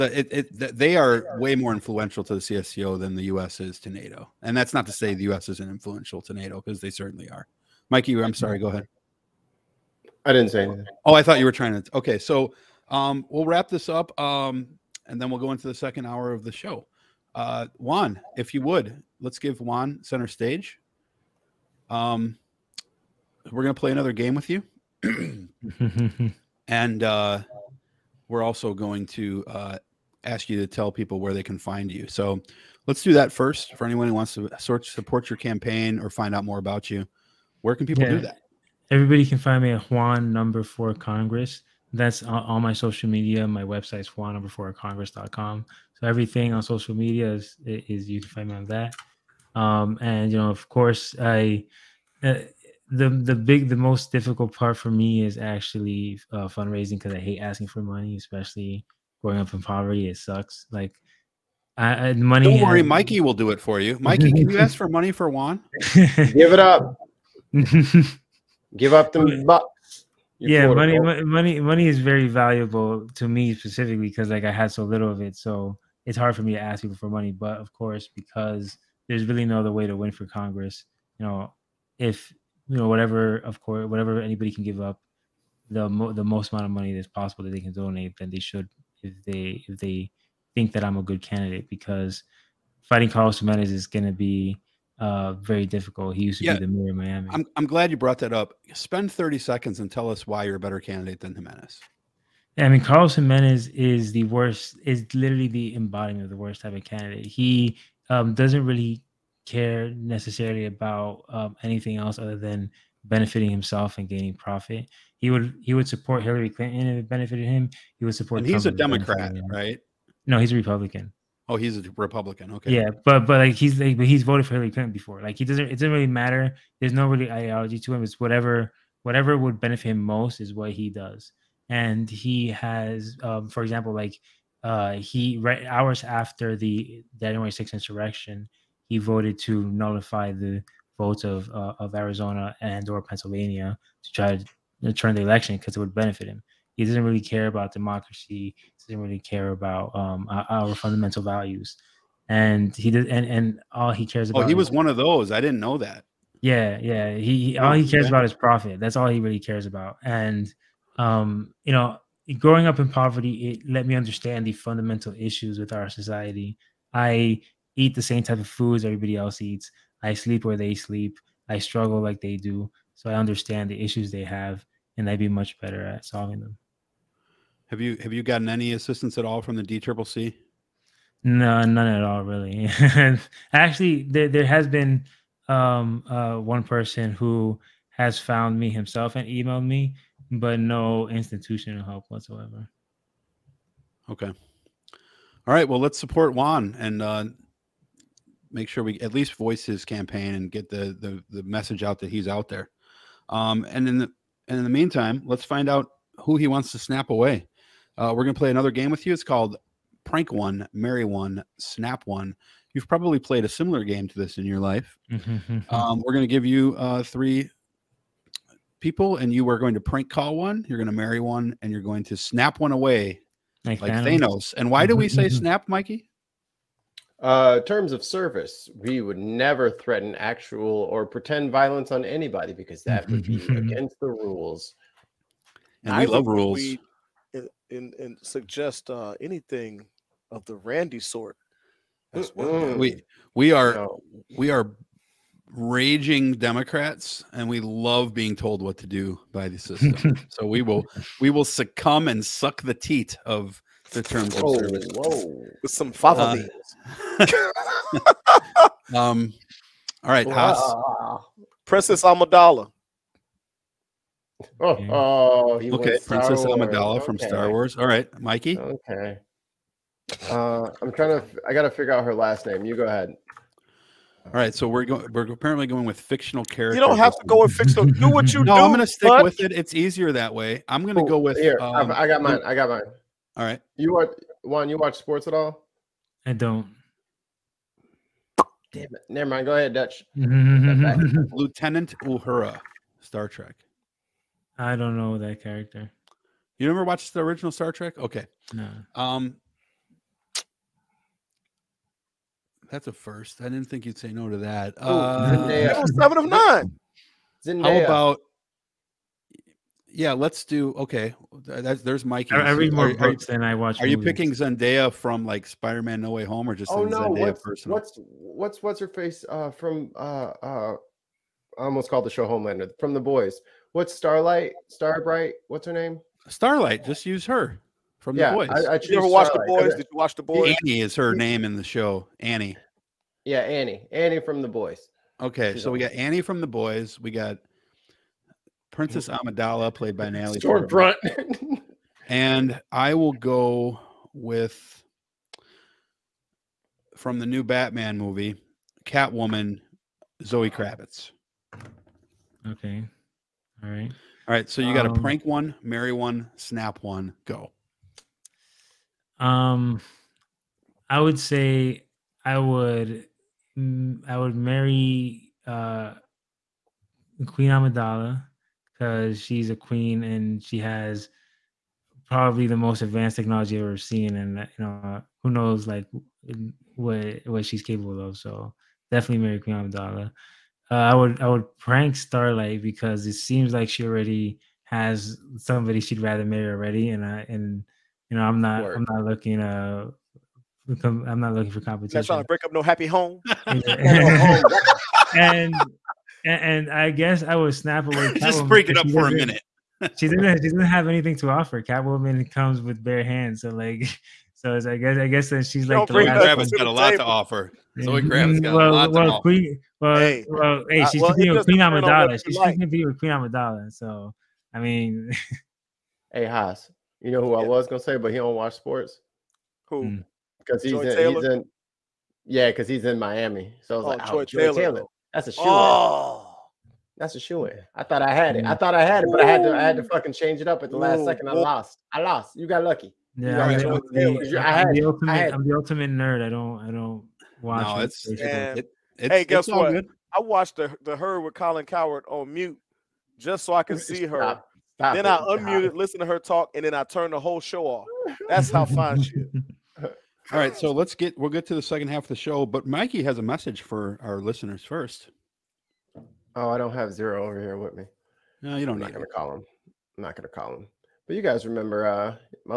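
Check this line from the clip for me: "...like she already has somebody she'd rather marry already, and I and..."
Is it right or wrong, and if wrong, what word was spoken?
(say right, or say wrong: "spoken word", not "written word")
right.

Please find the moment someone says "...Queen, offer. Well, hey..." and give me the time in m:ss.
6:49.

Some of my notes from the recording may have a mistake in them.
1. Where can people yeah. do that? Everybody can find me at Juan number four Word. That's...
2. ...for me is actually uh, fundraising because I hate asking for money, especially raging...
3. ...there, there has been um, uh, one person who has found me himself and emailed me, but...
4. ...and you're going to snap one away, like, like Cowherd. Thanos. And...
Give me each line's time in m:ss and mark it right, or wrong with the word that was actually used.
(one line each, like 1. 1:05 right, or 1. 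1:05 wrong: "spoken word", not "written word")
1. 0:37 wrong: "Congress", not "Word"
2. 0:54 wrong: "growing", not "raging"
3. 3:04 right
4. 3:41 wrong: "Thanos", not "Cowherd".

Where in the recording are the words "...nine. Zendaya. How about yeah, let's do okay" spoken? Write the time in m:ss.
5:06.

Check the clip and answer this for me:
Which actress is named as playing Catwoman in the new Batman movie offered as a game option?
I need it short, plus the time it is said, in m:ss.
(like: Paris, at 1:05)
Zoe Kravitz, at 5:50.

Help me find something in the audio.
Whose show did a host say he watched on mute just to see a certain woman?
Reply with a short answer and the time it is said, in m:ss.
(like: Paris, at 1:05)
Colin Cowherd, at 7:21.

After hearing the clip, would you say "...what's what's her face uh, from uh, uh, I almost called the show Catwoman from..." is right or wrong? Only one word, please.
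wrong.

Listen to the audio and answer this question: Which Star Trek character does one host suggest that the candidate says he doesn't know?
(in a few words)
Lieutenant Uhura.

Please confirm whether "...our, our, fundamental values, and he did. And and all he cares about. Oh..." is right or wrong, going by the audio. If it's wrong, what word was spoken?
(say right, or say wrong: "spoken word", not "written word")
right.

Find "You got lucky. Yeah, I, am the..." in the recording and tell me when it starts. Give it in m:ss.
7:12.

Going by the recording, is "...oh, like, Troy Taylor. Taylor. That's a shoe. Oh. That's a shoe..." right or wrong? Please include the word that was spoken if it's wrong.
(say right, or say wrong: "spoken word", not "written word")
right.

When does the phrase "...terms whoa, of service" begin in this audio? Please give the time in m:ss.
4:14.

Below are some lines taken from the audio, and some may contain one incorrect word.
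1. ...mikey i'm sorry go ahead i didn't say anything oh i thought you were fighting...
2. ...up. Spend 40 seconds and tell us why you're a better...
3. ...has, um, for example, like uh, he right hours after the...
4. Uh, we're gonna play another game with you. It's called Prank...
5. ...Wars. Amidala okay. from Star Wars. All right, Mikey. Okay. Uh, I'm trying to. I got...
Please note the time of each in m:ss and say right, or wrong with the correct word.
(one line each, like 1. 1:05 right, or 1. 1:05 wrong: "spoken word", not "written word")
1. 0:07 wrong: "trying", not "fighting"
2. 1:38 wrong: "30", not "40"
3. 2:12 right
4. 3:27 right
5. 4:26 right.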